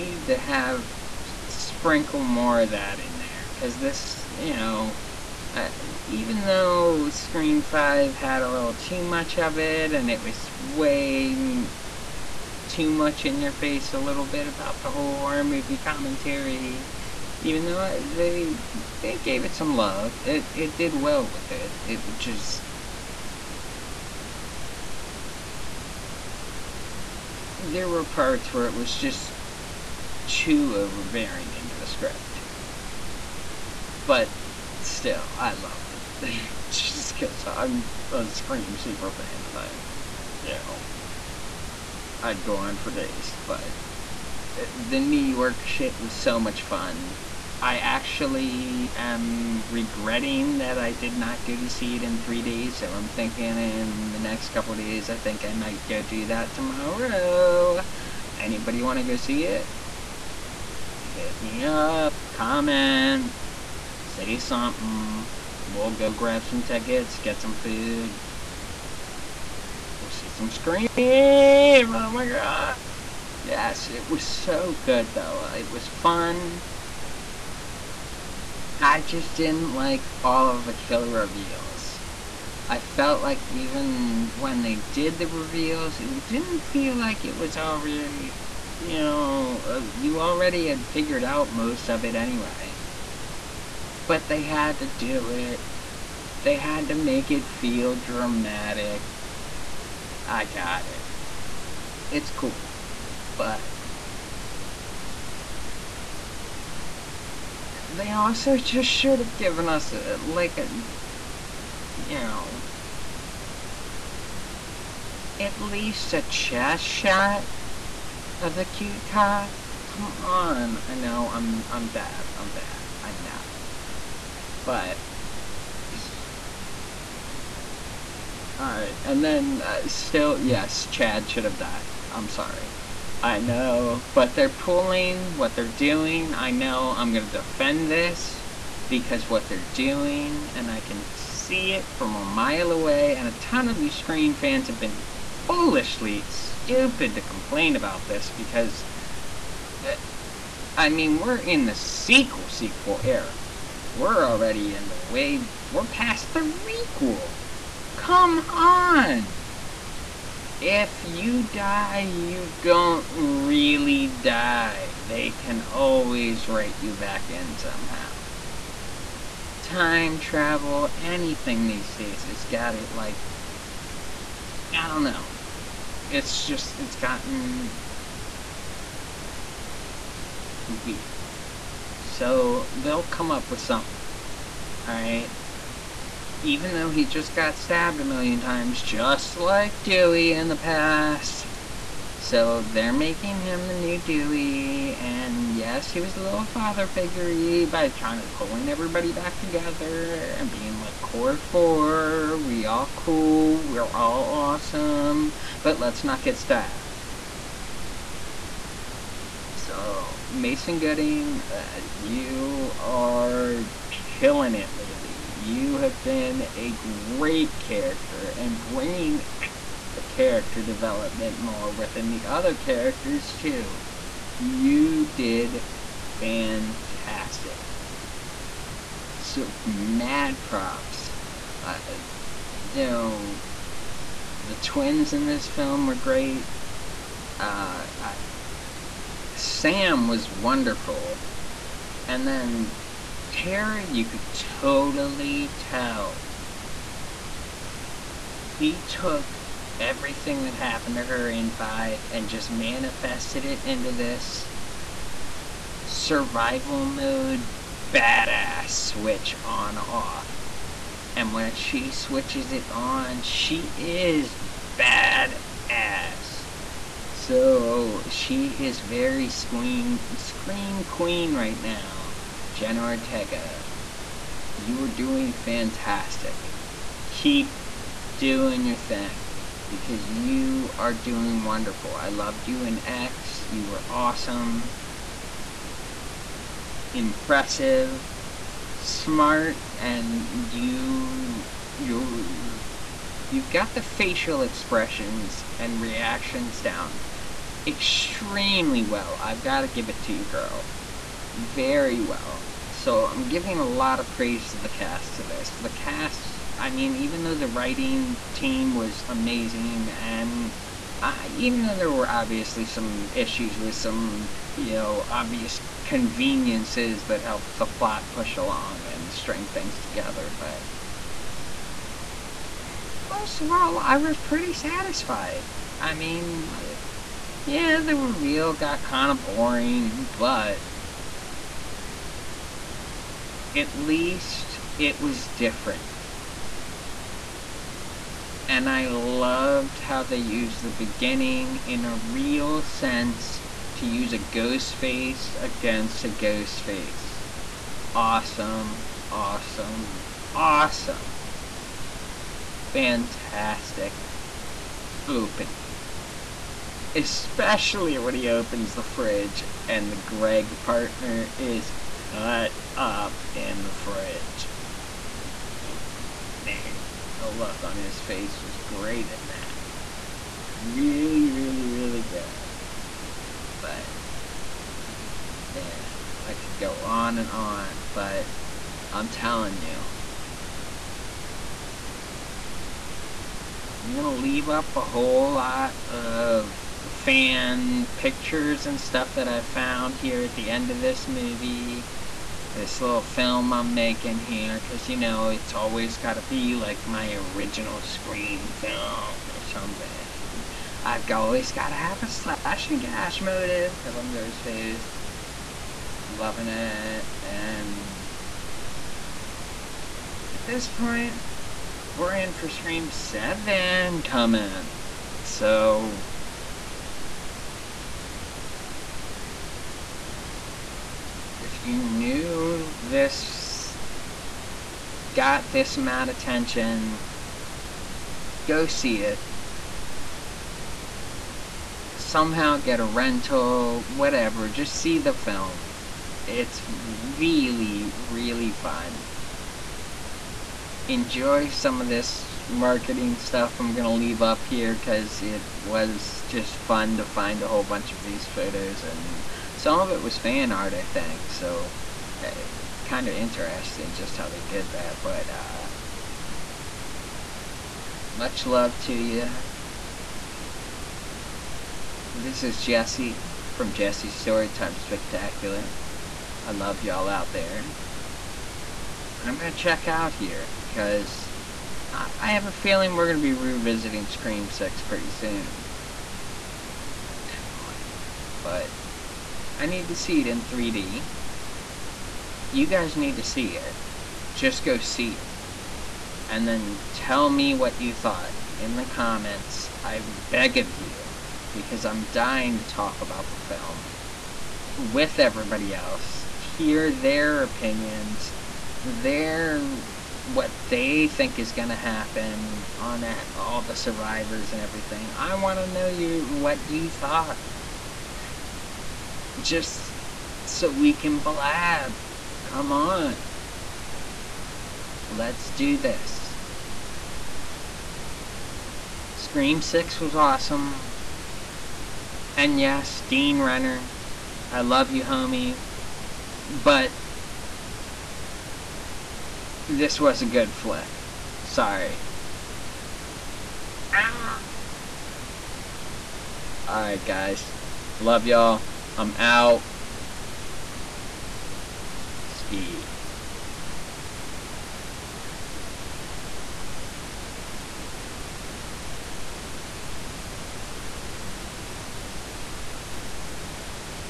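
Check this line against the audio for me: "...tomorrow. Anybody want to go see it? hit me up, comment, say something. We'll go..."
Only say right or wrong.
right.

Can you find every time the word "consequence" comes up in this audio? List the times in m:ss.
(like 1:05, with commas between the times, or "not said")
not said.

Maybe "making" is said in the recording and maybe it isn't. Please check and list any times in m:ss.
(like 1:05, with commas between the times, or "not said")
3:12, 6:33.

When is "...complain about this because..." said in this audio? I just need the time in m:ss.
2:27.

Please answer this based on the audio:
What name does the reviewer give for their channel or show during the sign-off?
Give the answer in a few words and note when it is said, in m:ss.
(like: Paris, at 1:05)
Jesse's Storytime Spectacular, at 7:43.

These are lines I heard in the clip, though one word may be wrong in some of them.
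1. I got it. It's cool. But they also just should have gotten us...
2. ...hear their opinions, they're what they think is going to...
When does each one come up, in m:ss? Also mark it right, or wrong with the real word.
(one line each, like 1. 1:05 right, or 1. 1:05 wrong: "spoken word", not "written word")
1. 1:40 wrong: "given", not "gotten"
2. 8:16 right.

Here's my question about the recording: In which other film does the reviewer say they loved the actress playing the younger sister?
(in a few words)
X.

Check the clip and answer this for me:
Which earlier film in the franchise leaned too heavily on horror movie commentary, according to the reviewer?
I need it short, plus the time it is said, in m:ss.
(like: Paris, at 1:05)
Scream 5, at 0:07.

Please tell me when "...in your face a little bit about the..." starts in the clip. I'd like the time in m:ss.
0:13.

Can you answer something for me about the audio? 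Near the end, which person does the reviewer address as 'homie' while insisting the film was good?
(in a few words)
Dean Renner.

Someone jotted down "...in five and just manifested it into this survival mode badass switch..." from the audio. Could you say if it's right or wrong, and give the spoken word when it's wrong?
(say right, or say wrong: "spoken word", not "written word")
right.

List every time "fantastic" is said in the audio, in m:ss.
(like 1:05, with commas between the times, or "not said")
3:46, 4:35, 5:52.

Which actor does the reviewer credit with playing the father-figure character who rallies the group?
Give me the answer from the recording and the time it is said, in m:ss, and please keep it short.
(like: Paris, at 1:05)
Mason Gooding, at 3:30.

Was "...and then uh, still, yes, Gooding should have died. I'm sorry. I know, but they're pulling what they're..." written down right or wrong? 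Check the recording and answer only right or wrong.
wrong.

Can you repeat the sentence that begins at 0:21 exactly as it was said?
It just there were parts where it was just too overbearing into the script.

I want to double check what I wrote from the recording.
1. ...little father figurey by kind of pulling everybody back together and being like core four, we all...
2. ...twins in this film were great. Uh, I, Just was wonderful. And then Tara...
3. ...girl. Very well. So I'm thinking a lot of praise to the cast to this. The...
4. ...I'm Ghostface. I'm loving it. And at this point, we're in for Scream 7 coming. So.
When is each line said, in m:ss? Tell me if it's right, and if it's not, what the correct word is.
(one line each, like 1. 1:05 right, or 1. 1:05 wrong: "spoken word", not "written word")
1. 3:16 right
2. 3:54 wrong: "Sam", not "Just"
3. 5:00 wrong: "giving", not "thinking"
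4. 6:43 right.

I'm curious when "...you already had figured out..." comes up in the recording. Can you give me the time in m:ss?
1:29.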